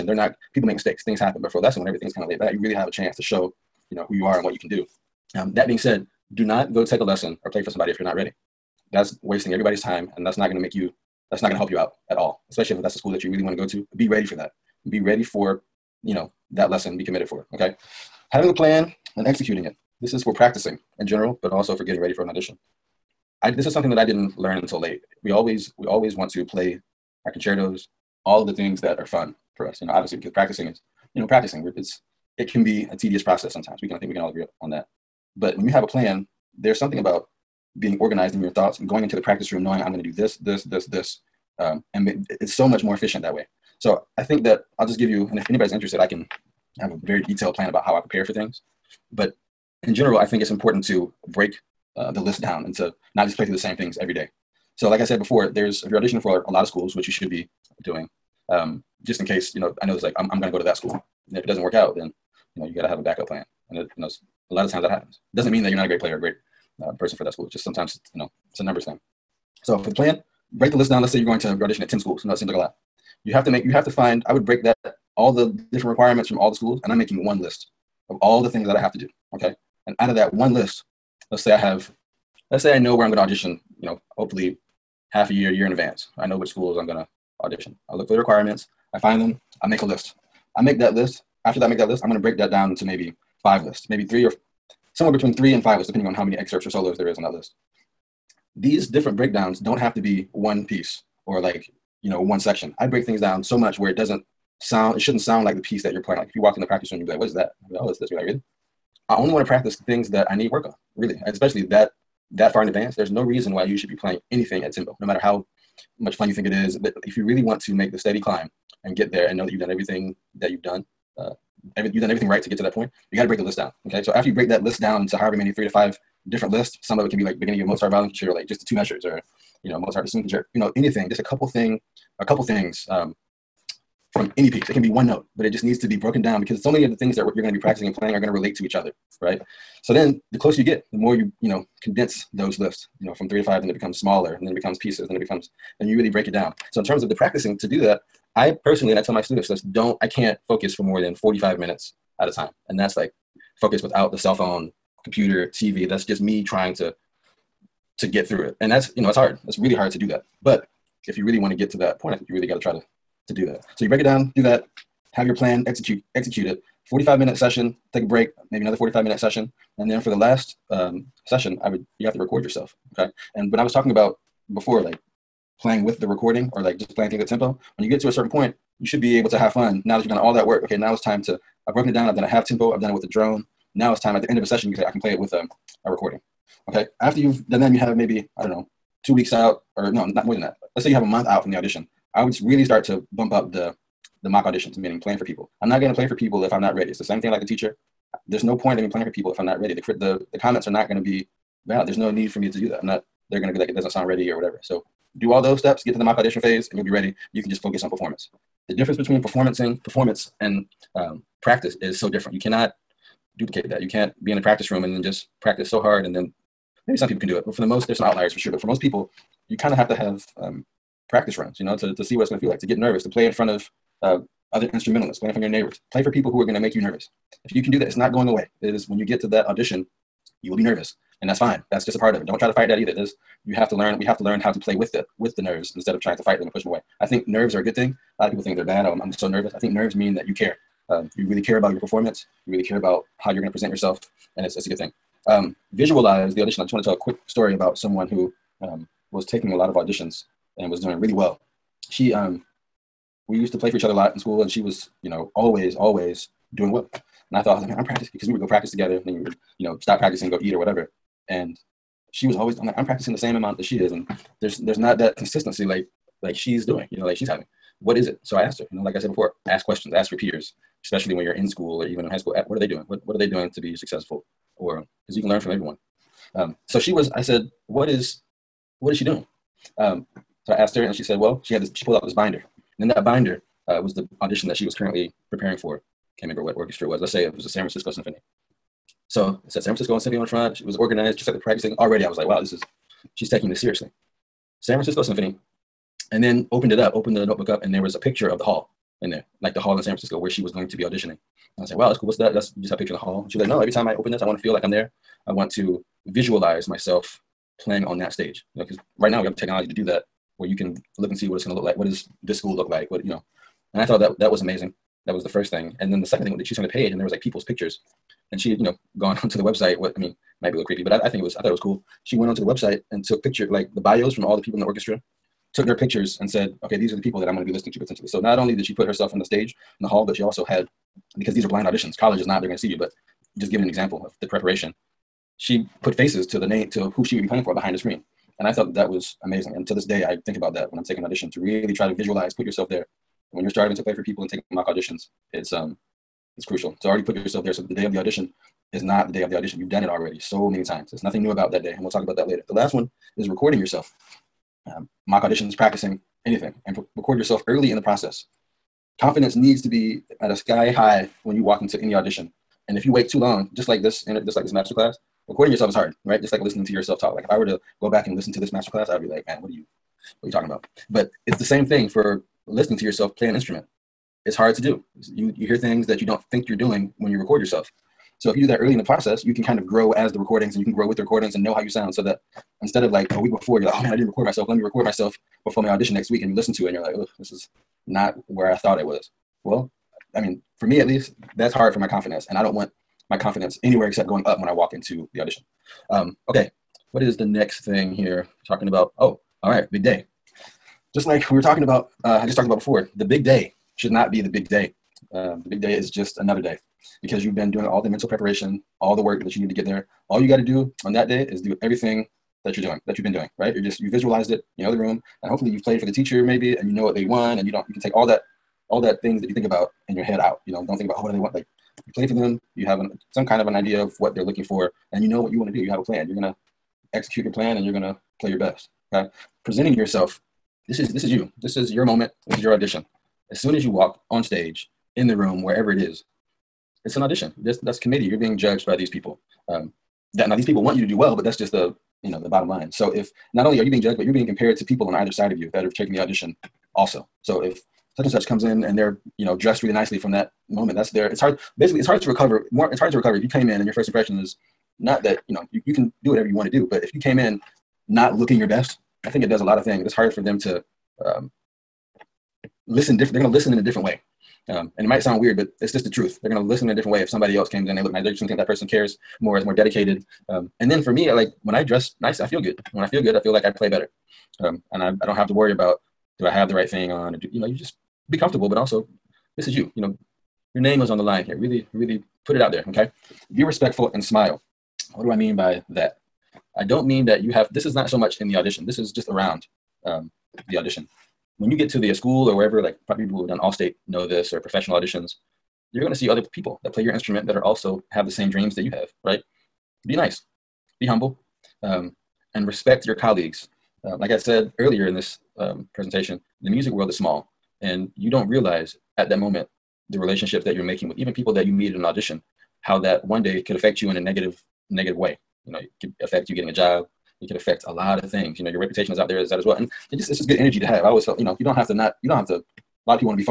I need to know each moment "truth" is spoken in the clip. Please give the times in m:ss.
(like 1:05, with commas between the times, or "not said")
7:45.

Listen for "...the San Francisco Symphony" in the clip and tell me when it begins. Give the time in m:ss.
4:47.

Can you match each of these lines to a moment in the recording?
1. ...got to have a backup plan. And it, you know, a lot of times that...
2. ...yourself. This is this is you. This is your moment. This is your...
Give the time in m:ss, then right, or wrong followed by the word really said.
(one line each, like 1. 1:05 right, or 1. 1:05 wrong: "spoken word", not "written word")
1. 1:02 right
2. 7:09 right.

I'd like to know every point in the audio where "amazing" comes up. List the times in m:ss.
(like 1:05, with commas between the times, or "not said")
5:14, 5:39.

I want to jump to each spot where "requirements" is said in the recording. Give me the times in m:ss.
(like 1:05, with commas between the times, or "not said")
1:15, 1:28.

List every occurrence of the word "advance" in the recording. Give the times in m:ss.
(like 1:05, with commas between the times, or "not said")
1:25, 1:52.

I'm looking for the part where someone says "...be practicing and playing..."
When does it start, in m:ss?
2:17.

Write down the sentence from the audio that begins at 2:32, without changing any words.
And that's like focus without the cell phone, computer, TV.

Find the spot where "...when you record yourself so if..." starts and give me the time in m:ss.
6:16.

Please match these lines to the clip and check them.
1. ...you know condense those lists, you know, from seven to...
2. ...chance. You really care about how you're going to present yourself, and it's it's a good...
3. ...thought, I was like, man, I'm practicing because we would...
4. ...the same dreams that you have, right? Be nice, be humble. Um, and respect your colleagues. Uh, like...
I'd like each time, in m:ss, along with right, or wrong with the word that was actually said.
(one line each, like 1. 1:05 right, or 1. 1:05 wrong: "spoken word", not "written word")
1. 2:21 wrong: "three", not "seven"
2. 4:01 wrong: "performance", not "chance"
3. 4:17 right
4. 8:18 right.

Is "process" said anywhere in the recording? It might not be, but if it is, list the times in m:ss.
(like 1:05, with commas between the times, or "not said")
0:33, 5:57, 6:18.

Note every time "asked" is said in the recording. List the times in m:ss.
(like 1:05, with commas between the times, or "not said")
4:28, 4:40.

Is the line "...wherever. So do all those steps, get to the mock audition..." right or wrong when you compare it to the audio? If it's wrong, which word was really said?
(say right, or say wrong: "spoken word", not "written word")
wrong: "whatever", not "wherever".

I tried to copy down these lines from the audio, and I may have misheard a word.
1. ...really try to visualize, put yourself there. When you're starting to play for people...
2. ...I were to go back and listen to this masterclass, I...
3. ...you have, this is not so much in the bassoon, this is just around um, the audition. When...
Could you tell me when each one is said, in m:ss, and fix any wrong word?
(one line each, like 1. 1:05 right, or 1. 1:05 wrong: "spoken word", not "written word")
1. 5:41 right
2. 6:07 right
3. 8:07 wrong: "audition", not "bassoon".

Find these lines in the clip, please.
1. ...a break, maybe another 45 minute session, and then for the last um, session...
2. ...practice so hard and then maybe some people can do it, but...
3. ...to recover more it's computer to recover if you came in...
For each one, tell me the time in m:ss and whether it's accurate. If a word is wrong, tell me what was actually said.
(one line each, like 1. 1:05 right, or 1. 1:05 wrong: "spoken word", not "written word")
1. 2:48 right
2. 3:35 right
3. 7:32 wrong: "harder", not "computer".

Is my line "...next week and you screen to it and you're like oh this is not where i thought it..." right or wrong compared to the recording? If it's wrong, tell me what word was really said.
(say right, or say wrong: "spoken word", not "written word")
wrong: "listen", not "screen".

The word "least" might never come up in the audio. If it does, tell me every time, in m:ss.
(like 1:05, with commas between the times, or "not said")
6:30.